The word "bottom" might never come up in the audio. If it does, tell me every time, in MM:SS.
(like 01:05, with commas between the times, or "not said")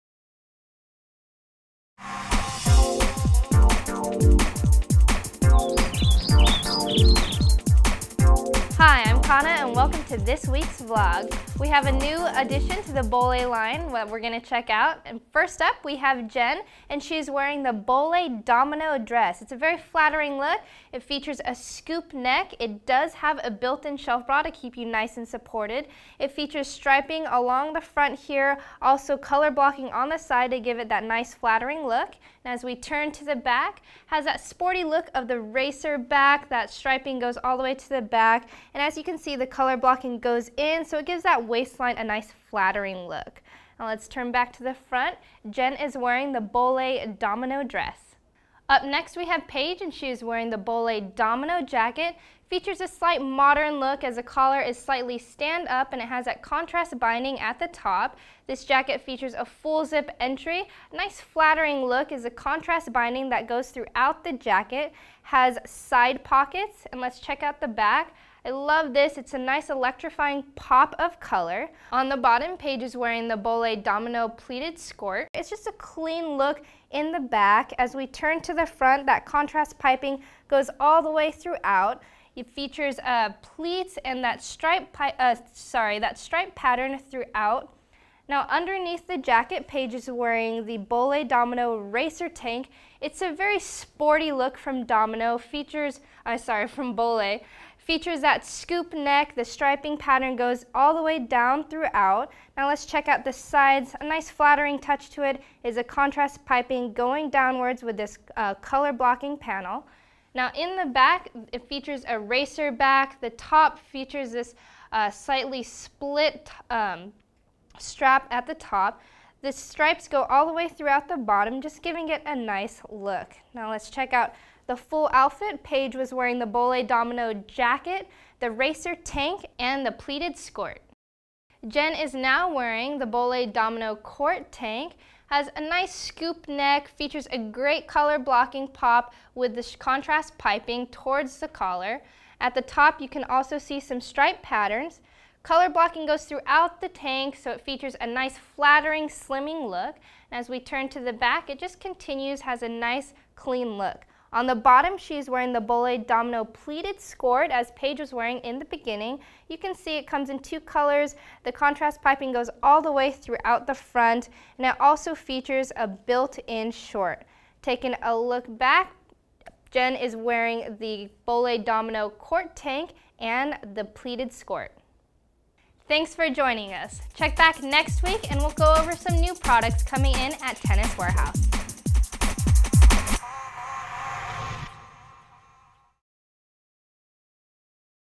01:12, 02:01, 02:34.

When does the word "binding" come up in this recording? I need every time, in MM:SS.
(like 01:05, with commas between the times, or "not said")
00:56, 01:02.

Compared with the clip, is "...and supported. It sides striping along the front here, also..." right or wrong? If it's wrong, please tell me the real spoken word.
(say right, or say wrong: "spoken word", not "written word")
wrong: "features", not "sides".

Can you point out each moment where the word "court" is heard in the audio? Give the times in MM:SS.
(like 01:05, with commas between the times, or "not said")
02:13, 02:52.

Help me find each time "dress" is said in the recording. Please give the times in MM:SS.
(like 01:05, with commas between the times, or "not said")
00:18, 00:47.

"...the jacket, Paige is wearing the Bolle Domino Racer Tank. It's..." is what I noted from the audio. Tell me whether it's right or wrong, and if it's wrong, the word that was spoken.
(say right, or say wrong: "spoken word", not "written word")
right.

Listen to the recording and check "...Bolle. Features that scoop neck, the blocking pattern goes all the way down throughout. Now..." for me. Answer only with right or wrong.
wrong.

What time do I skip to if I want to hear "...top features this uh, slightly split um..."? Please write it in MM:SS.
01:53.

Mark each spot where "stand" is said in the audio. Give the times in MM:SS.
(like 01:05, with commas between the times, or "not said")
00:55.